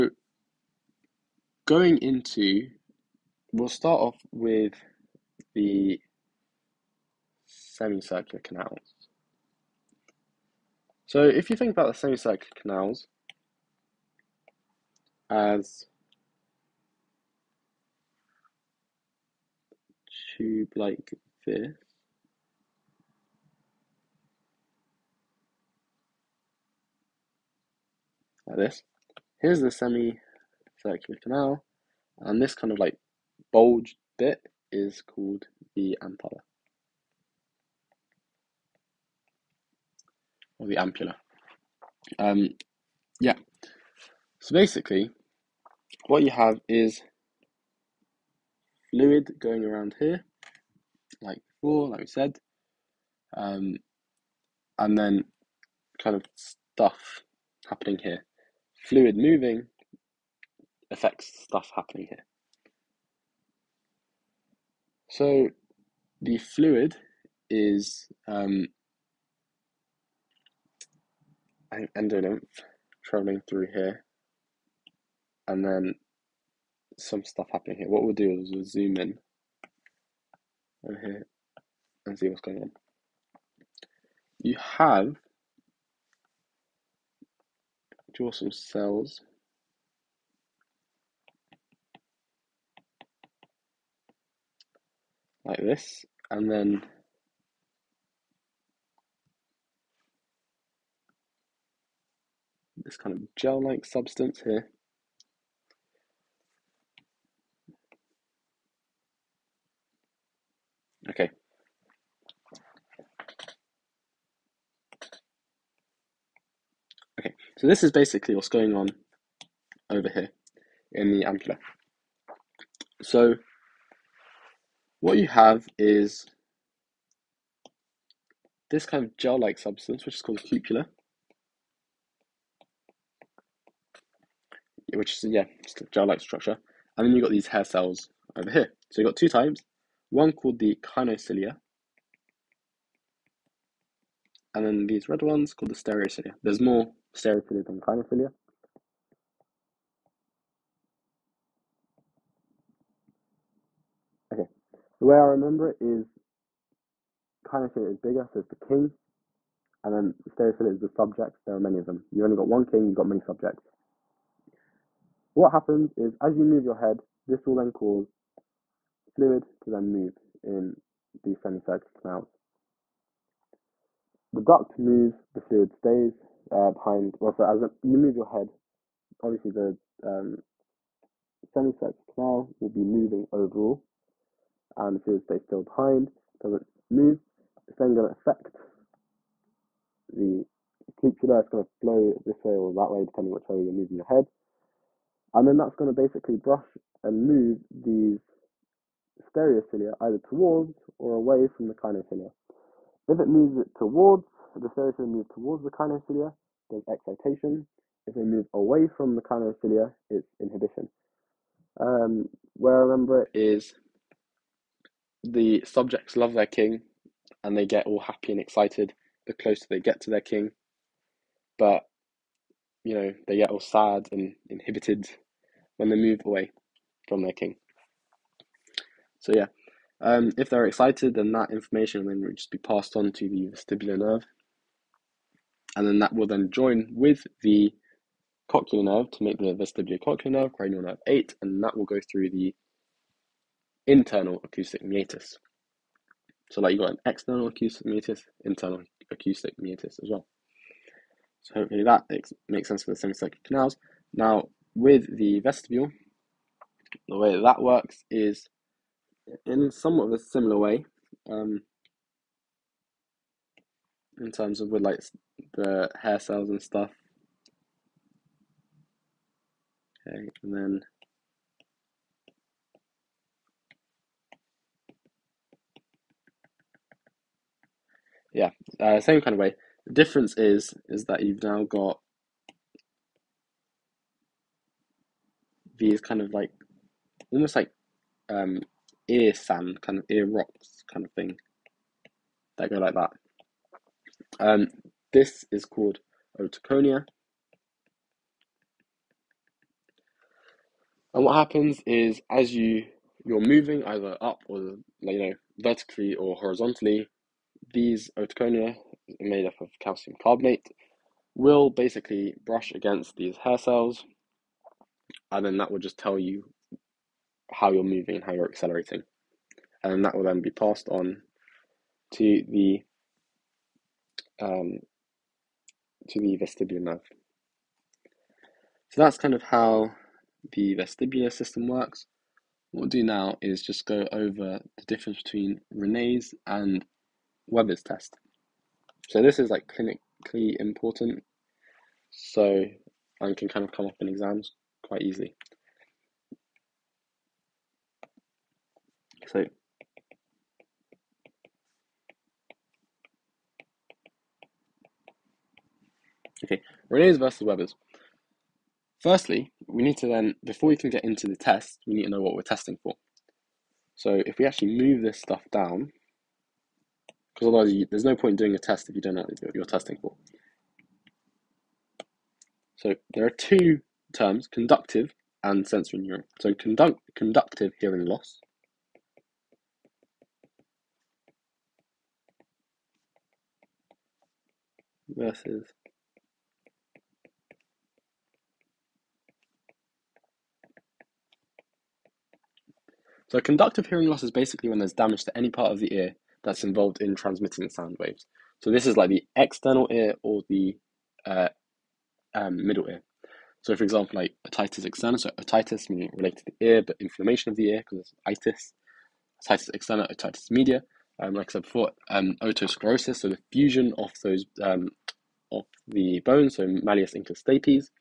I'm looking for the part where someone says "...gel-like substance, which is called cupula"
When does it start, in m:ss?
2:09.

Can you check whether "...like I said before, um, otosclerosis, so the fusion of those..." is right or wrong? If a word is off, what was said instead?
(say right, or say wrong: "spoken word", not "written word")
right.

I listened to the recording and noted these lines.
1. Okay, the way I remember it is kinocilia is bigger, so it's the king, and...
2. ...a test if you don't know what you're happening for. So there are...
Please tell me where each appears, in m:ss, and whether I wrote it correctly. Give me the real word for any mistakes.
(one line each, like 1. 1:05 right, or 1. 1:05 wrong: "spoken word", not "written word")
1. 2:34 right
2. 6:08 wrong: "testing", not "happening".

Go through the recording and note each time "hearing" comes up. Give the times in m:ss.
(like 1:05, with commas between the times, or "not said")
6:17, 6:33.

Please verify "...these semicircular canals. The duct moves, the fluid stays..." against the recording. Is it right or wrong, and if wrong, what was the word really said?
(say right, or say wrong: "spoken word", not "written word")
right.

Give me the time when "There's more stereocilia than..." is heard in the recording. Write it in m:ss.
2:26.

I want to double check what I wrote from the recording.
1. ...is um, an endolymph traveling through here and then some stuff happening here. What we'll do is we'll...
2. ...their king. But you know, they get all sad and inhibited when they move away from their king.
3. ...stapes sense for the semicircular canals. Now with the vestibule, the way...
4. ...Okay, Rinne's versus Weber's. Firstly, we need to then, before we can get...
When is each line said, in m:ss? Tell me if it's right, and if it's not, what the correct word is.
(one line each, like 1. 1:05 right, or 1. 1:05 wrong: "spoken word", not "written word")
1. 1:07 right
2. 3:40 right
3. 4:12 wrong: "makes", not "stapes"
4. 5:56 right.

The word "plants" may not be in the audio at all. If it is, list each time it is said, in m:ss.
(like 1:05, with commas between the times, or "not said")
not said.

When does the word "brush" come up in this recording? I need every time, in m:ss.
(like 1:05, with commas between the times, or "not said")
3:16, 5:12.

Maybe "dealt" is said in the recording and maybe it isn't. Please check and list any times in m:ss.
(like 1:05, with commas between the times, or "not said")
not said.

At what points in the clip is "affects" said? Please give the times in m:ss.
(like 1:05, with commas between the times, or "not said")
1:00, 3:08.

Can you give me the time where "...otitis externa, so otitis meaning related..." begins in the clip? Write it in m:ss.
6:44.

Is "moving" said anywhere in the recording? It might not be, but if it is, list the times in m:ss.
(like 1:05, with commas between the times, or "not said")
0:59, 3:02, 3:13, 5:03, 5:17.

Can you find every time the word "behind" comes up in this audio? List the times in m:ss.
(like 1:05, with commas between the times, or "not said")
2:56, 3:05.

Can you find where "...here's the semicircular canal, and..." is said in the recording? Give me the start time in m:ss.
0:29.